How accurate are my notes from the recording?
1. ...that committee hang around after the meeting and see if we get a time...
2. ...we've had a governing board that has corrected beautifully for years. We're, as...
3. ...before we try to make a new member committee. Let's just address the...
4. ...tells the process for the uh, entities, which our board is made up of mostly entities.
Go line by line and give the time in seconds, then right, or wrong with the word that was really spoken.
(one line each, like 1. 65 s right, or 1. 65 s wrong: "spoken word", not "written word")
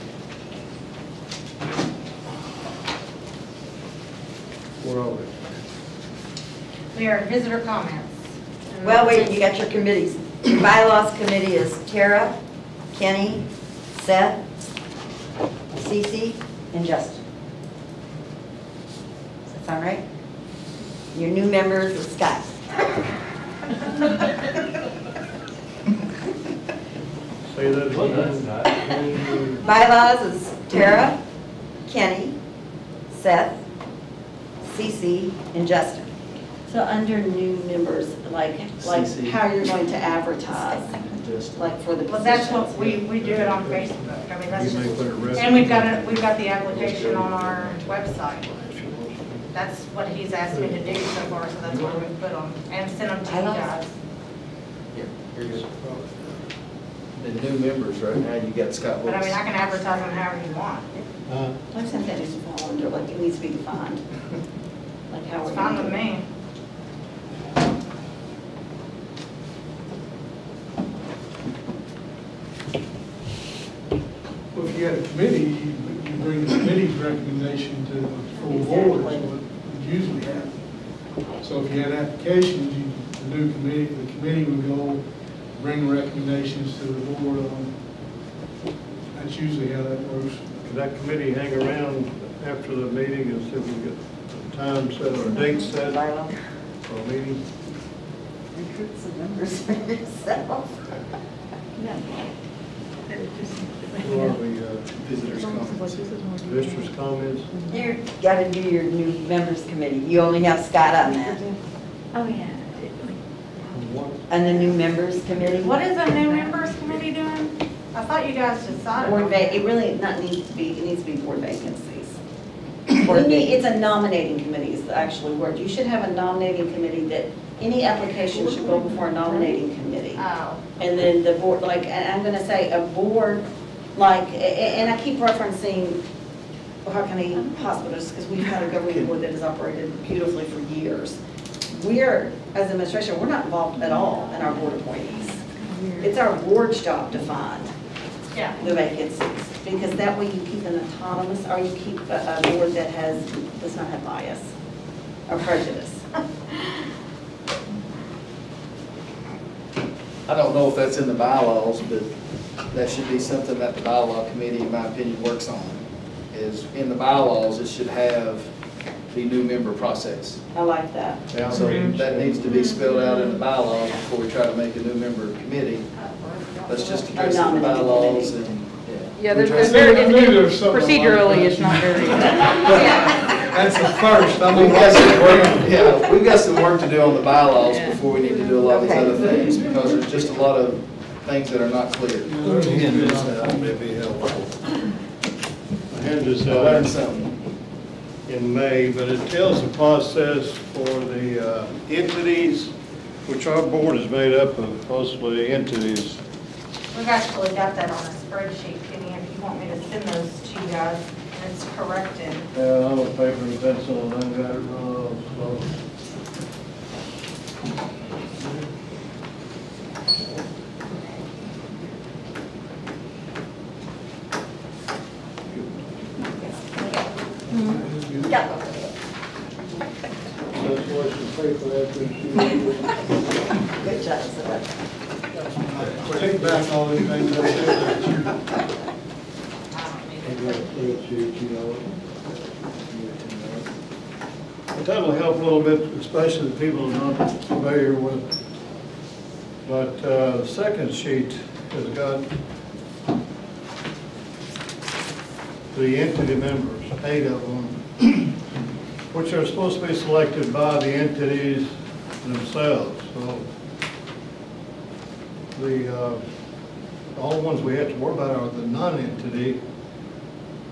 1. 90 s right
2. 138 s wrong: "operated", not "corrected"
3. 173 s right
4. 199 s right.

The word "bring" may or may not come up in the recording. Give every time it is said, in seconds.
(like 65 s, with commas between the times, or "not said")
76 s, 85 s.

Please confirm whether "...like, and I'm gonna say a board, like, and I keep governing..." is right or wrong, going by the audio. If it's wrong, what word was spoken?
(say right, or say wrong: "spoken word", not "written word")
wrong: "referencing", not "governing".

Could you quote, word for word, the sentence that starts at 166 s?
Is in the bylaws, it should have the new member process.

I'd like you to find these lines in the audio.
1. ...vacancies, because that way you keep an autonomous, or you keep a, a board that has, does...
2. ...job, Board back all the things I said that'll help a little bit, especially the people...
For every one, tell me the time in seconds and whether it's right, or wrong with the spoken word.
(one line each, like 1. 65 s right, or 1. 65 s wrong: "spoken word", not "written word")
1. 148 s right
2. 234 s wrong: "Take", not "Board".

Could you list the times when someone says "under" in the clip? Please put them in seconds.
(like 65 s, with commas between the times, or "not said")
36 s.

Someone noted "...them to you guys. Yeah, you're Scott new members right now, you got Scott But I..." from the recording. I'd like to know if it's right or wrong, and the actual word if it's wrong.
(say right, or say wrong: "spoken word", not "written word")
wrong: "The", not "Scott".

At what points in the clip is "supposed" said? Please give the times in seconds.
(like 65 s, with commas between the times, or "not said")
259 s.